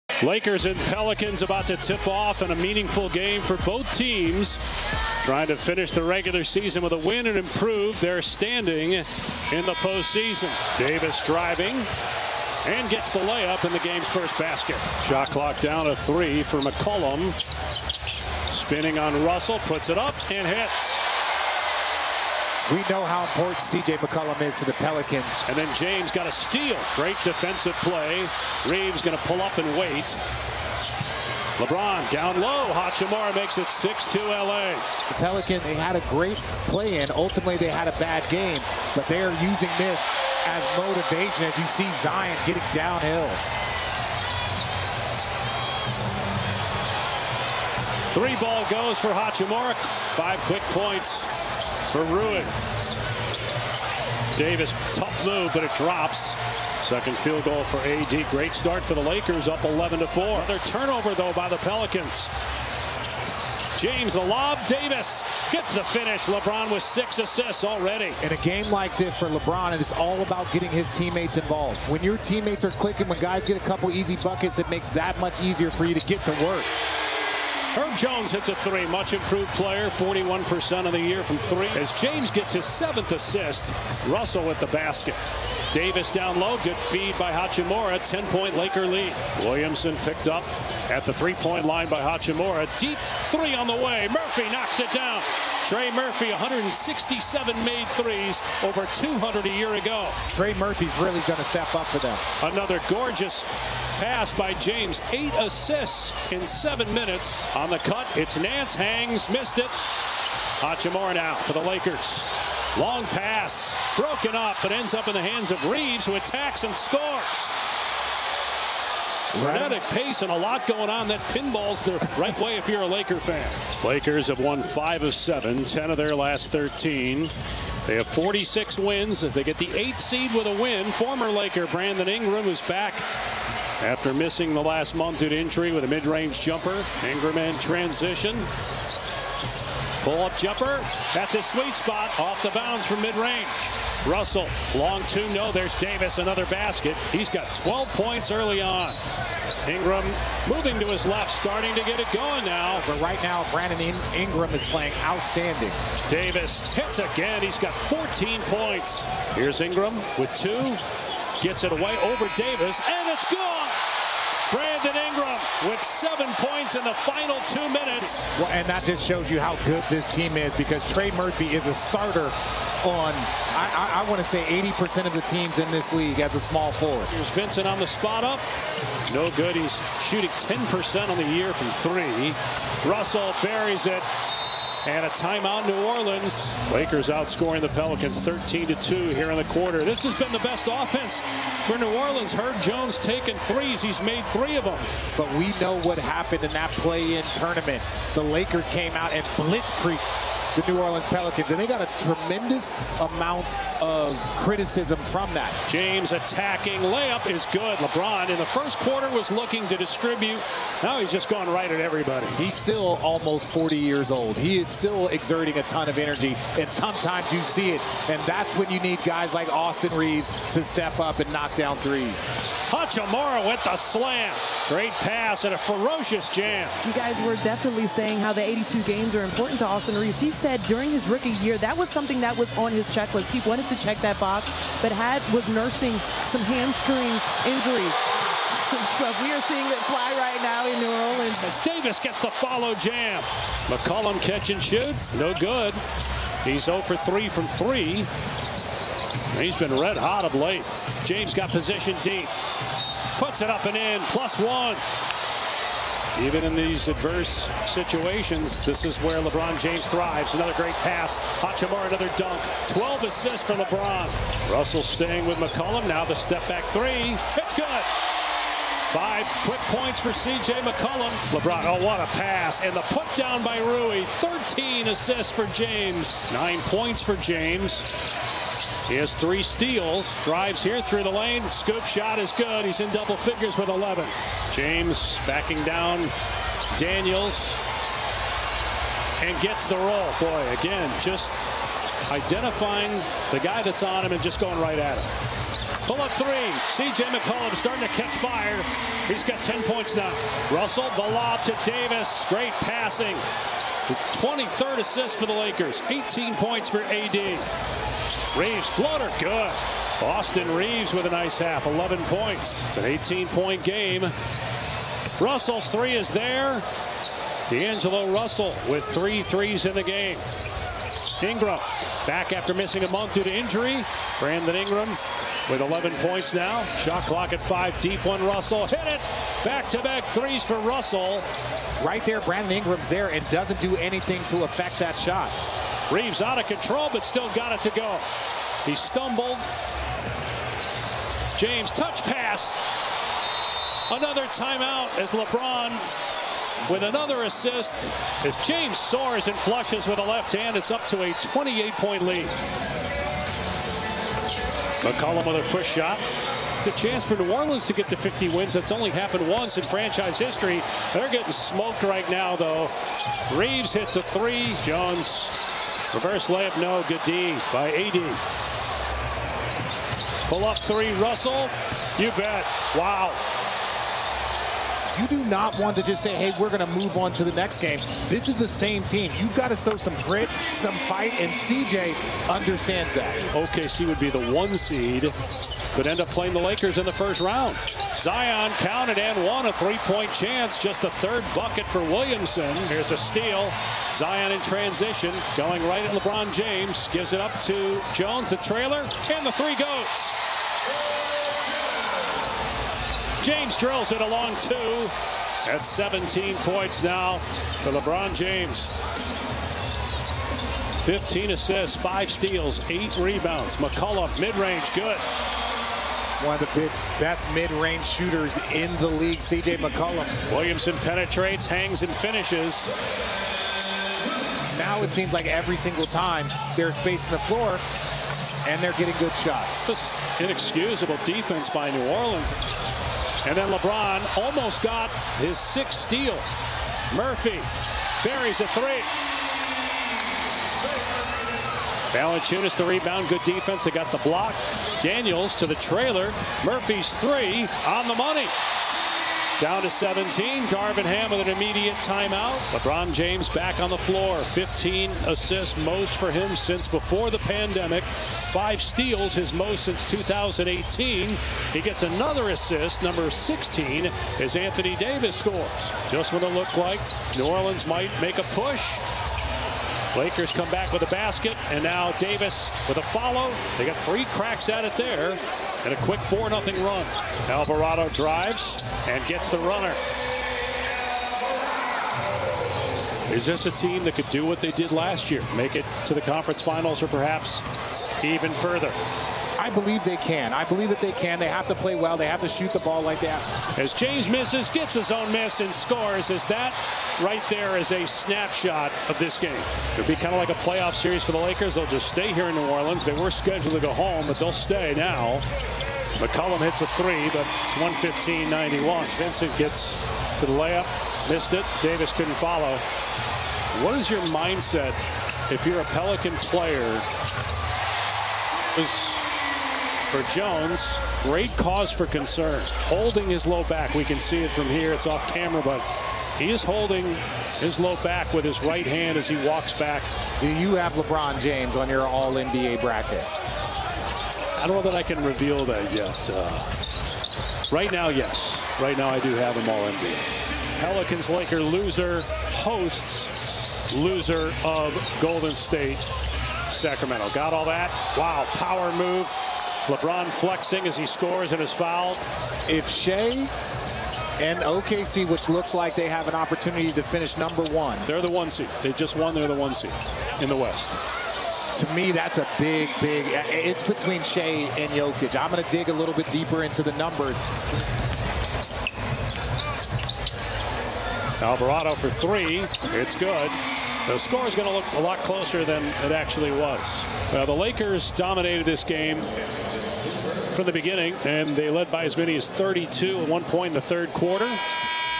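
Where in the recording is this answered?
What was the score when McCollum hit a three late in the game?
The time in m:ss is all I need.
8:28.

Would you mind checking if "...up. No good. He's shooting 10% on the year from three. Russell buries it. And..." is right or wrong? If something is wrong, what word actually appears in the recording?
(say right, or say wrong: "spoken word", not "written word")
right.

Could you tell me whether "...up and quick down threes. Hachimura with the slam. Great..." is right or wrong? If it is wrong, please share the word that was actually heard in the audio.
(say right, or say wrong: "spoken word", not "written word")
wrong: "knock", not "quick".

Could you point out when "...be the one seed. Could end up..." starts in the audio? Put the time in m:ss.
6:23.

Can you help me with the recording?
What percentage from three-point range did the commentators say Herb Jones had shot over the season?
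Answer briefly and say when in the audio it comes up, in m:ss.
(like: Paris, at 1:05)
41%, at 1:19.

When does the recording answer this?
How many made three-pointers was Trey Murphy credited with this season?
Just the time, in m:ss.
1:36.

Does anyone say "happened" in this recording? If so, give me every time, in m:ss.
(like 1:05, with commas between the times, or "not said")
3:15, 5:58.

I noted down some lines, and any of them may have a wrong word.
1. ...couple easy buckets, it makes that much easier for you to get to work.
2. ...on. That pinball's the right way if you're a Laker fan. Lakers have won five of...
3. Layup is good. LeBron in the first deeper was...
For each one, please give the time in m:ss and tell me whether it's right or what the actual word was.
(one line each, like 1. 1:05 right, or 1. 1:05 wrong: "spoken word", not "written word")
1. 1:13 right
2. 2:00 right
3. 3:26 wrong: "quarter", not "deeper".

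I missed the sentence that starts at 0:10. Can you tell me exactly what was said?
Davis driving and gets the layup in the game's first basket.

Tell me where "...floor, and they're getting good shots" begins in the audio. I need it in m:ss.
7:07.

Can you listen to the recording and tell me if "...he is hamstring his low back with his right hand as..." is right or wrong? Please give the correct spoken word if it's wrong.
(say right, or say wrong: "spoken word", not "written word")
wrong: "holding", not "hamstring".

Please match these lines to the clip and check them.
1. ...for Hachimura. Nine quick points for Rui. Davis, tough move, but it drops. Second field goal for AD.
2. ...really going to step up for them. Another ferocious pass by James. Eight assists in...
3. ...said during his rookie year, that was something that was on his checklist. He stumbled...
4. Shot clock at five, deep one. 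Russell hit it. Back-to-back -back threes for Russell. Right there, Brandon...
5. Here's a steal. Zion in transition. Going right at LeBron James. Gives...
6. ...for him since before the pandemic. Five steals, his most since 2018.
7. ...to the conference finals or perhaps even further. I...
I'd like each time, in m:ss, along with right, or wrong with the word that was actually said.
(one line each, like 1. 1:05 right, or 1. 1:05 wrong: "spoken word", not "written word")
1. 0:48 wrong: "Five", not "Nine"
2. 1:40 wrong: "gorgeous", not "ferocious"
3. 3:50 wrong: "wanted", not "stumbled"
4. 5:26 right
5. 6:32 right
6. 7:35 right
7. 8:05 right.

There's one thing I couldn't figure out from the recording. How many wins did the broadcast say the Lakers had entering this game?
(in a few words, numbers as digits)
46.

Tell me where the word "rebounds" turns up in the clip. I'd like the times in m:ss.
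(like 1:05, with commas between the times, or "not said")
6:52, 7:22.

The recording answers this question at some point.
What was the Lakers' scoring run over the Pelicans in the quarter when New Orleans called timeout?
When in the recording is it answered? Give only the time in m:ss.
3:08.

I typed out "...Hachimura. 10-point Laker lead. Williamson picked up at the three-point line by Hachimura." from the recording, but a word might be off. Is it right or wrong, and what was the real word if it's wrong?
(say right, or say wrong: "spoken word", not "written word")
right.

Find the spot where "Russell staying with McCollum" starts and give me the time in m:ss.
4:24.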